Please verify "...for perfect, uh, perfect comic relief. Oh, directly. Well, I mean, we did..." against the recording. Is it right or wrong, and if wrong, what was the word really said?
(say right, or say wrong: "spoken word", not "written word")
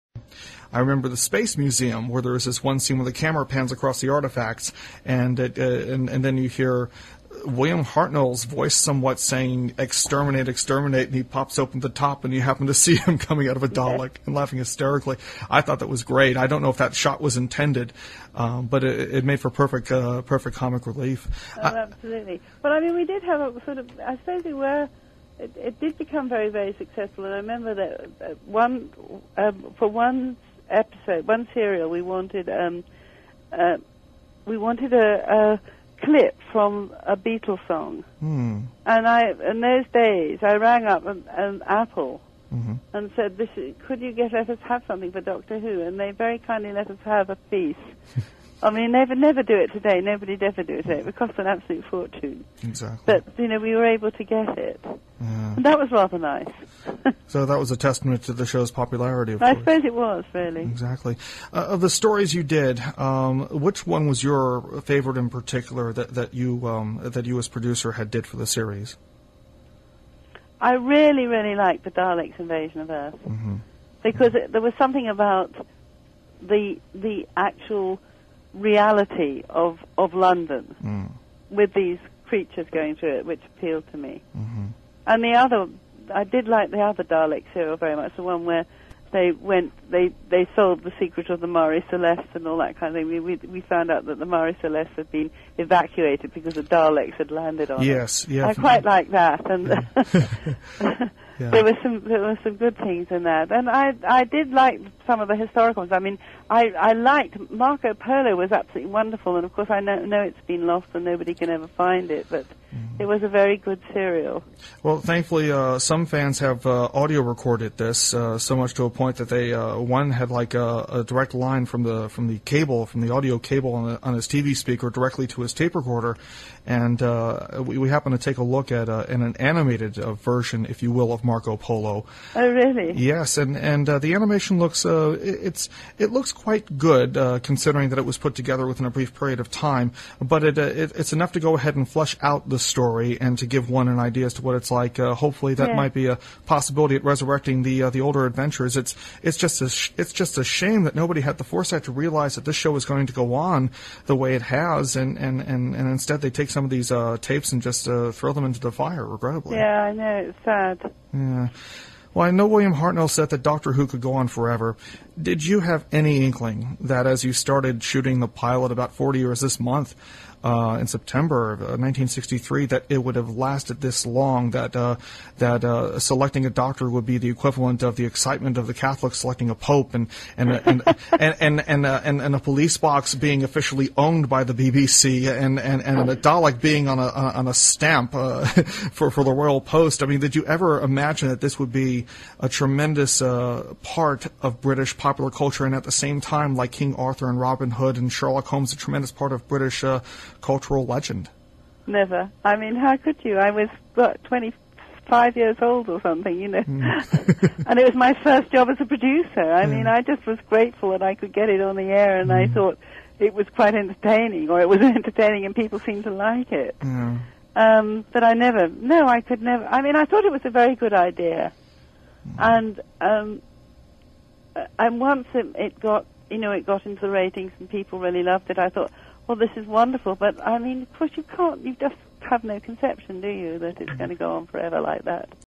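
wrong: "absolutely", not "directly".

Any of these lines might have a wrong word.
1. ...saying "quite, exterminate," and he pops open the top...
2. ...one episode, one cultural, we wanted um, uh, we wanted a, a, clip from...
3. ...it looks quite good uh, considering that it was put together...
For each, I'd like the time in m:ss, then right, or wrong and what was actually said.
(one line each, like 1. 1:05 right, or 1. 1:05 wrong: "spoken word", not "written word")
1. 0:09 wrong: "exterminate", not "quite"
2. 0:29 wrong: "serial", not "cultural"
3. 2:15 right.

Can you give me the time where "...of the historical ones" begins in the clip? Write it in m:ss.
1:45.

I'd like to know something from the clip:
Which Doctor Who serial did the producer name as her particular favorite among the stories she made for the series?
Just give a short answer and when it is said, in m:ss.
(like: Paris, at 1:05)
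The Daleks' Invasion of Earth, at 1:11.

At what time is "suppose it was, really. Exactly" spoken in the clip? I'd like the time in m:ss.
0:59.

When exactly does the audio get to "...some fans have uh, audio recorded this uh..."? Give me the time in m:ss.
1:55.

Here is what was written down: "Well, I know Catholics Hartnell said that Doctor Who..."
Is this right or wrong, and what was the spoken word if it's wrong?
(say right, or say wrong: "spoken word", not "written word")
wrong: "William", not "Catholics".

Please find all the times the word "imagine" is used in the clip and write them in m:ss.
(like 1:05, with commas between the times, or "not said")
3:10.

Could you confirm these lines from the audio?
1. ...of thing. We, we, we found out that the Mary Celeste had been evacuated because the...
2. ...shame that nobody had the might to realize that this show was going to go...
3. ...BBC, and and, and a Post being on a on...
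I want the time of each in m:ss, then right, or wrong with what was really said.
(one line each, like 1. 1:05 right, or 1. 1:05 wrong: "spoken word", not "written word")
1. 1:32 right
2. 2:30 wrong: "foresight", not "might"
3. 3:04 wrong: "Dalek", not "Post".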